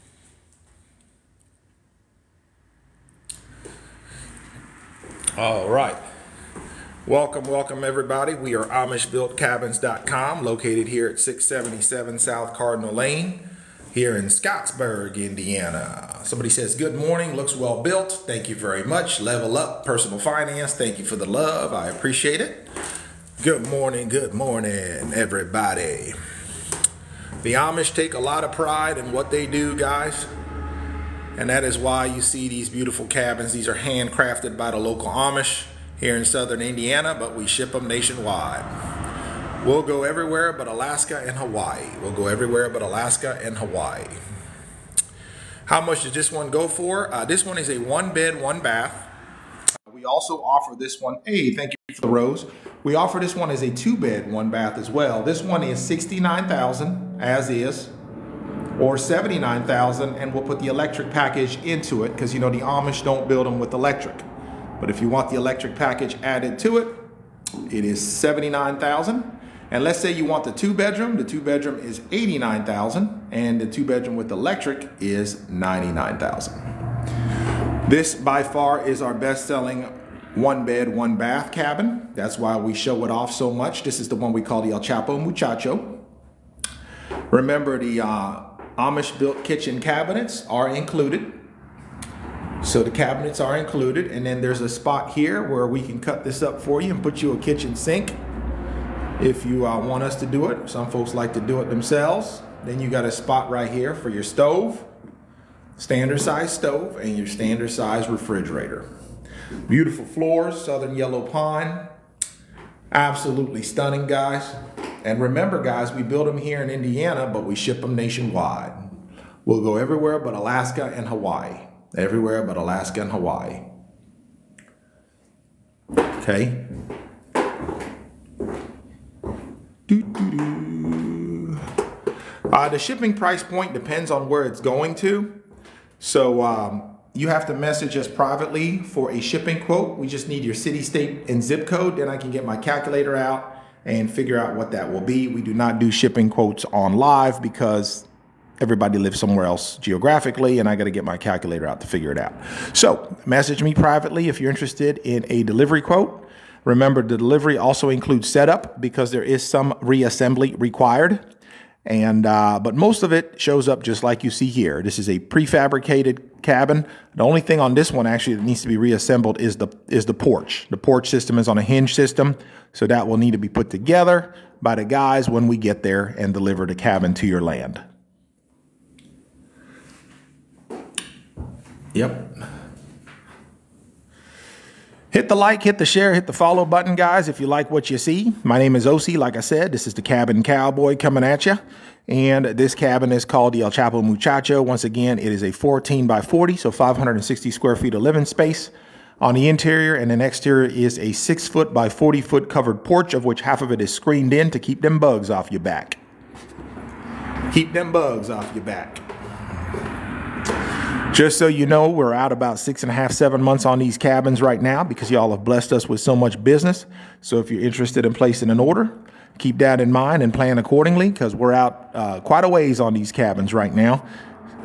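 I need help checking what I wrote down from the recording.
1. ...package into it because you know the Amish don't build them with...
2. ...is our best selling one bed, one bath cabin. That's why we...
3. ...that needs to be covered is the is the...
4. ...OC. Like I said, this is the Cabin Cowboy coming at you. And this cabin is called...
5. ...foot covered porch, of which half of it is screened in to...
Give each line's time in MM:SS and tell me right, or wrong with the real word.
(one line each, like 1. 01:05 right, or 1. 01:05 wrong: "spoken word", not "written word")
1. 01:01 right
2. 01:18 right
3. 02:48 wrong: "reassembled", not "covered"
4. 03:08 right
5. 03:22 right.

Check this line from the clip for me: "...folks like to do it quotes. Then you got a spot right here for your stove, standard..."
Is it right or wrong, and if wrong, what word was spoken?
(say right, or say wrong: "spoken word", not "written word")
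wrong: "themselves", not "quotes".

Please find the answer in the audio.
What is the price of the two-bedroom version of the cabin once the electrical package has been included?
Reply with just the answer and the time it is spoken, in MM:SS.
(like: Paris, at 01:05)
$99,000, at 01:15.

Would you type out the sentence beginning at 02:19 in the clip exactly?
We just need your city, state, and zip code.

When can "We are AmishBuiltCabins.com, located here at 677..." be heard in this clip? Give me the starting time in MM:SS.
00:08.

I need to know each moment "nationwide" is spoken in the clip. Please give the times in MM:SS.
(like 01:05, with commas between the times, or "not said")
00:37, 01:57.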